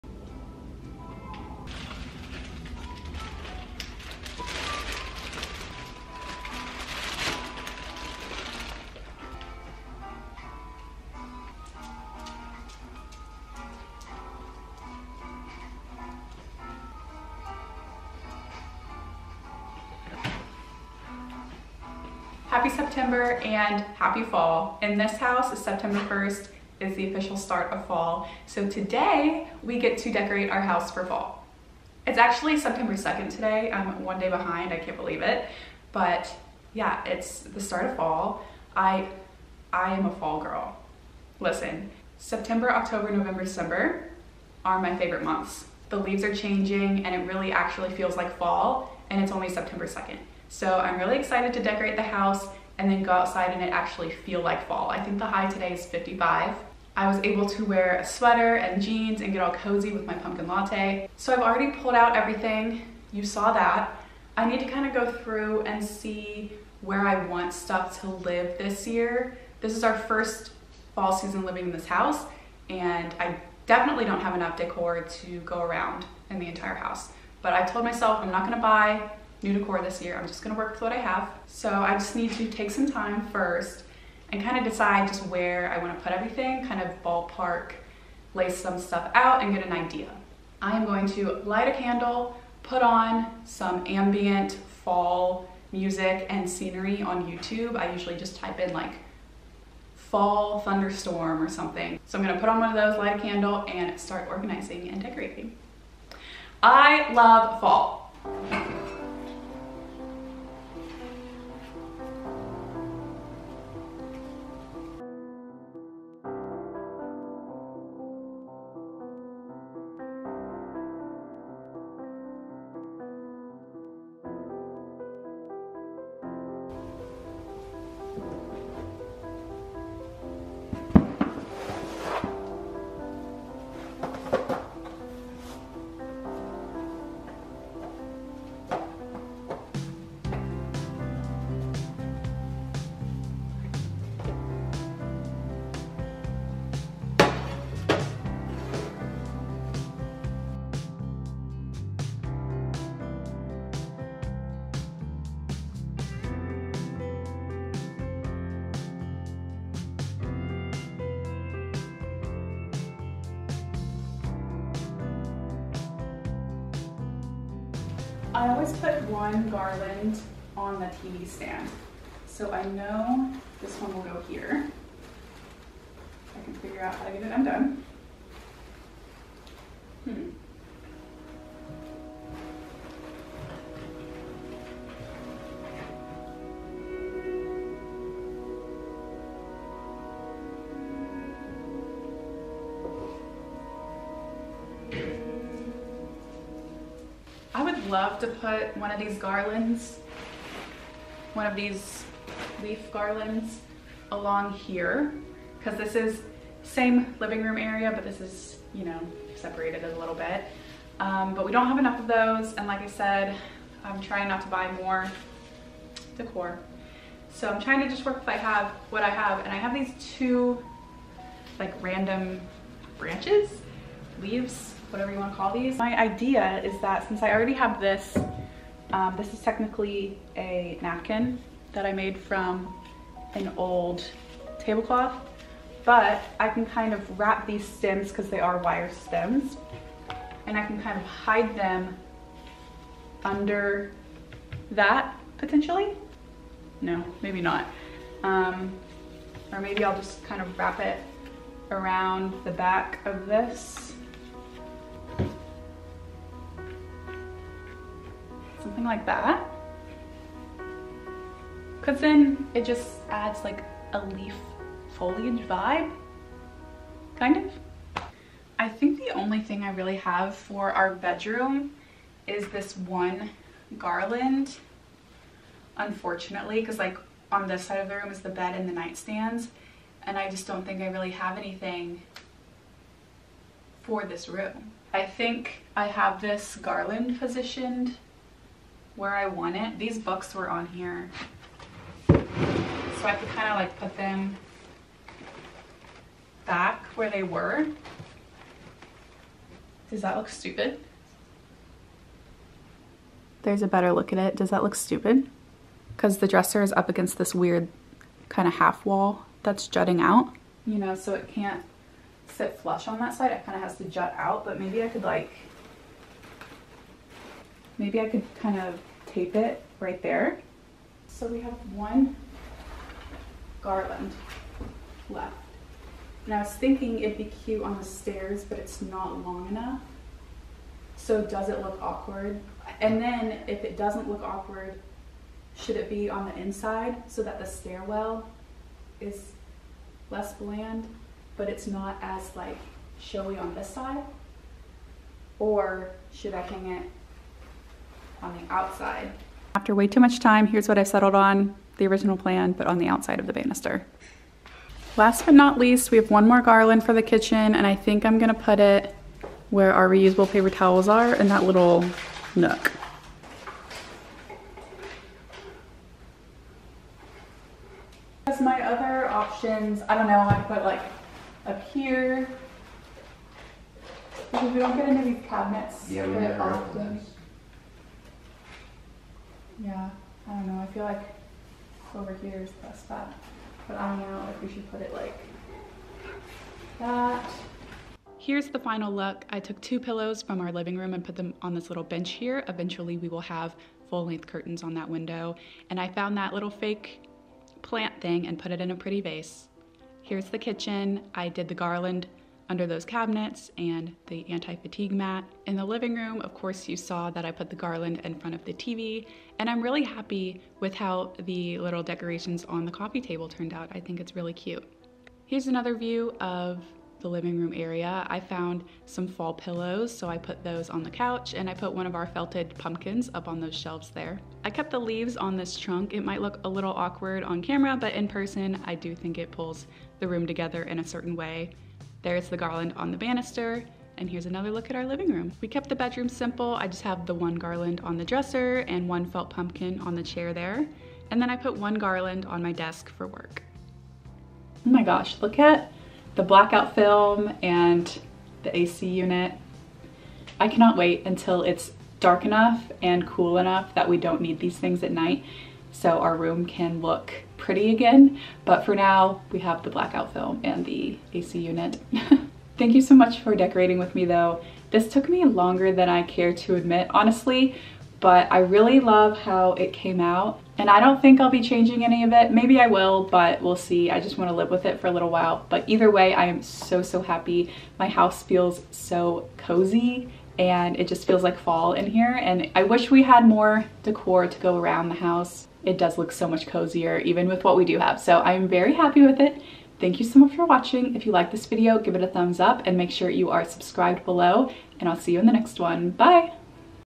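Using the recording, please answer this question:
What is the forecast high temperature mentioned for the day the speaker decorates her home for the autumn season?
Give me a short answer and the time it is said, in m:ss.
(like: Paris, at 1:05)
55, at 0:55.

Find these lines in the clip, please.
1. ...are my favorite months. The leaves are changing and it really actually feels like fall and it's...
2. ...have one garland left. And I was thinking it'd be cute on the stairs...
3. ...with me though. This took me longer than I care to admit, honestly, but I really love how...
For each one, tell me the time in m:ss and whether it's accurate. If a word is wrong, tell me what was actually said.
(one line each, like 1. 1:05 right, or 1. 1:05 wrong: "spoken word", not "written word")
1. 0:44 right
2. 5:21 right
3. 7:43 right.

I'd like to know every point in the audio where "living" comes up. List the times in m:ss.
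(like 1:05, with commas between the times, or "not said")
1:11, 3:27, 6:30, 6:45, 6:57, 7:14.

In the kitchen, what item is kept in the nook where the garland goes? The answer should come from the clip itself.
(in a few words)
paper towels.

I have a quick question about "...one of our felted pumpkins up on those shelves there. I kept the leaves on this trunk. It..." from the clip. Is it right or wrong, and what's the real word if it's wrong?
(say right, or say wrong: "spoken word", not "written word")
right.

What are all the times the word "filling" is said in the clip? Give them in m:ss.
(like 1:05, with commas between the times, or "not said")
not said.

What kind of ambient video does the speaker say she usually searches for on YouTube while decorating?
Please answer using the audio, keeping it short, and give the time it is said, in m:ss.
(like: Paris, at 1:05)
fall thunderstorm, at 1:39.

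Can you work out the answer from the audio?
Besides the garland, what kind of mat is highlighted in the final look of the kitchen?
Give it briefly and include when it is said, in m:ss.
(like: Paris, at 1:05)
anti-fatigue mat, at 6:44.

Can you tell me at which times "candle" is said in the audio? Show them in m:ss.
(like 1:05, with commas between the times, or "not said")
1:31, 1:43.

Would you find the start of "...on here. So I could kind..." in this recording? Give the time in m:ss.
4:50.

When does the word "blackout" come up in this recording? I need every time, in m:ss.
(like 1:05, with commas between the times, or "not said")
7:26, 7:39.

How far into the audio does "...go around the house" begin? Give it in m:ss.
8:04.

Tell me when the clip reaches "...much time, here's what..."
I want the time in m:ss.
5:49.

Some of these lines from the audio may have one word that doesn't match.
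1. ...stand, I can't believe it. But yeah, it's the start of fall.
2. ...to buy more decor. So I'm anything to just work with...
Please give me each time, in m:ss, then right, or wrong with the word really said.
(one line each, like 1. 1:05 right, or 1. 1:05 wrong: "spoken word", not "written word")
1. 0:34 wrong: "behind", not "stand"
2. 3:34 wrong: "trying", not "anything".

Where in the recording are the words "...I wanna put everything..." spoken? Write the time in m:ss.
1:25.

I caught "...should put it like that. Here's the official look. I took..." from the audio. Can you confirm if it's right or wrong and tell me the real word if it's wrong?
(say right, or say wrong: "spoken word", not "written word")
wrong: "final", not "official".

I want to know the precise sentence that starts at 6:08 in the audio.
As my other options, I don't know, I put like up here.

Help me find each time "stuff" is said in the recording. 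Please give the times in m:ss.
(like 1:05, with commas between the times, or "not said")
1:07, 1:28.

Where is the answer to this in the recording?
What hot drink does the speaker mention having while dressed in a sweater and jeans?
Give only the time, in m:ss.
1:00.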